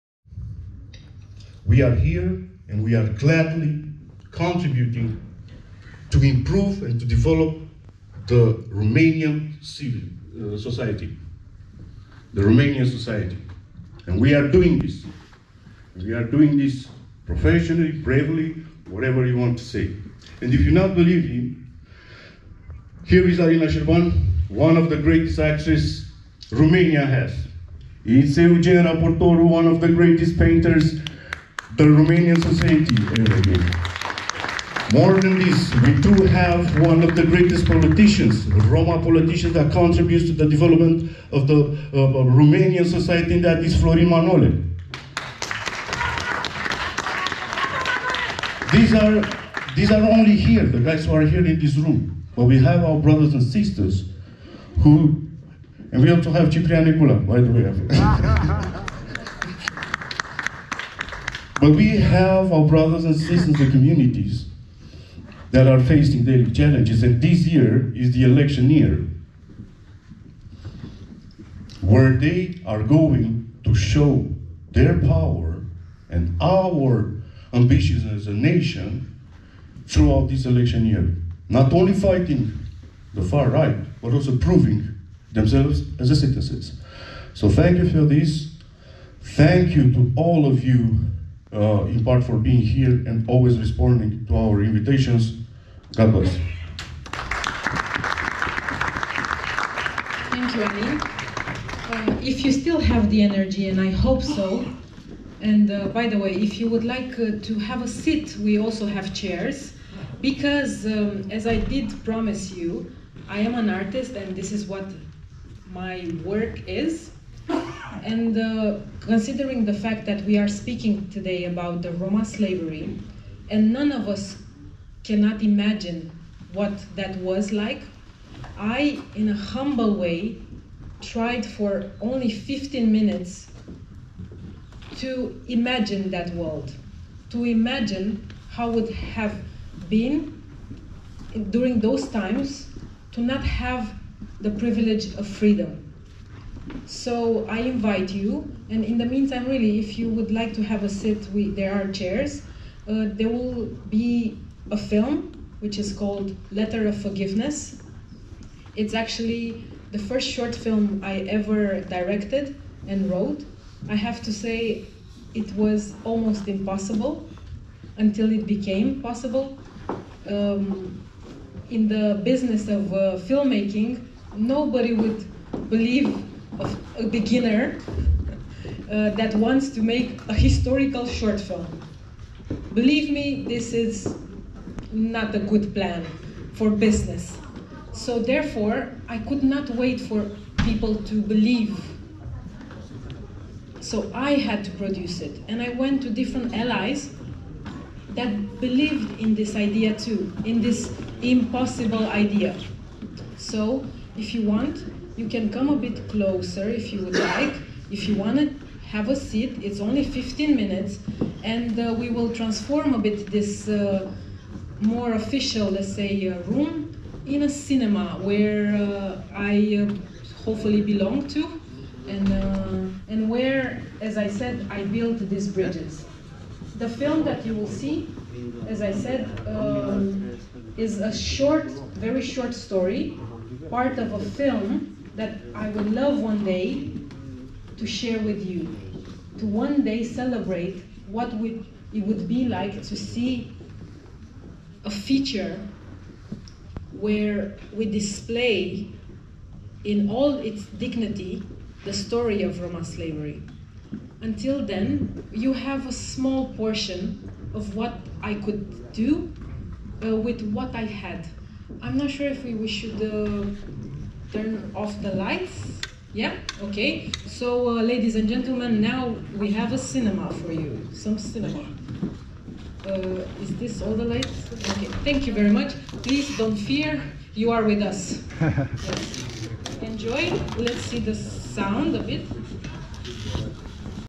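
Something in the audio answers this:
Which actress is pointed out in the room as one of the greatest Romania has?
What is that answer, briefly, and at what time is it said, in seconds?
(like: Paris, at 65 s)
Alina Șerban, at 23 s.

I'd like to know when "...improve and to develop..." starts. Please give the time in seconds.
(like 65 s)
6 s.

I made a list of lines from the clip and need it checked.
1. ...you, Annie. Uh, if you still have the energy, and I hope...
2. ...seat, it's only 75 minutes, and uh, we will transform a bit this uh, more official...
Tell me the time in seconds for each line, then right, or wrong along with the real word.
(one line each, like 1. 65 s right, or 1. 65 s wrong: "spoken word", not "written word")
1. 100 s right
2. 209 s wrong: "15", not "75".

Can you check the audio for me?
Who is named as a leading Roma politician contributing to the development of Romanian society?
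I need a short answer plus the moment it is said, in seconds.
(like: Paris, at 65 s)
Florin Manole, at 43 s.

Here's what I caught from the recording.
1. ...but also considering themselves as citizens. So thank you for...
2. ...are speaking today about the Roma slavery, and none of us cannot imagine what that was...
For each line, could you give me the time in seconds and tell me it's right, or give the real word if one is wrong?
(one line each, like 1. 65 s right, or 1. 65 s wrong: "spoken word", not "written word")
1. 84 s wrong: "proving", not "considering"
2. 120 s right.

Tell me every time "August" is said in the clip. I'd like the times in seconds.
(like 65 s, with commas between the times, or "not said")
not said.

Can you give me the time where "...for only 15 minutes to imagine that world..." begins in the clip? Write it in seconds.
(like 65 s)
131 s.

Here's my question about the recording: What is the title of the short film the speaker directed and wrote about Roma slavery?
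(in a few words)
Letter of Forgiveness.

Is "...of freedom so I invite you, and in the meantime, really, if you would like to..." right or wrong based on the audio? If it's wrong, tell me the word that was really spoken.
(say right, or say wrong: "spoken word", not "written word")
right.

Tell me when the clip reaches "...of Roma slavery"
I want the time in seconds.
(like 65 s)
252 s.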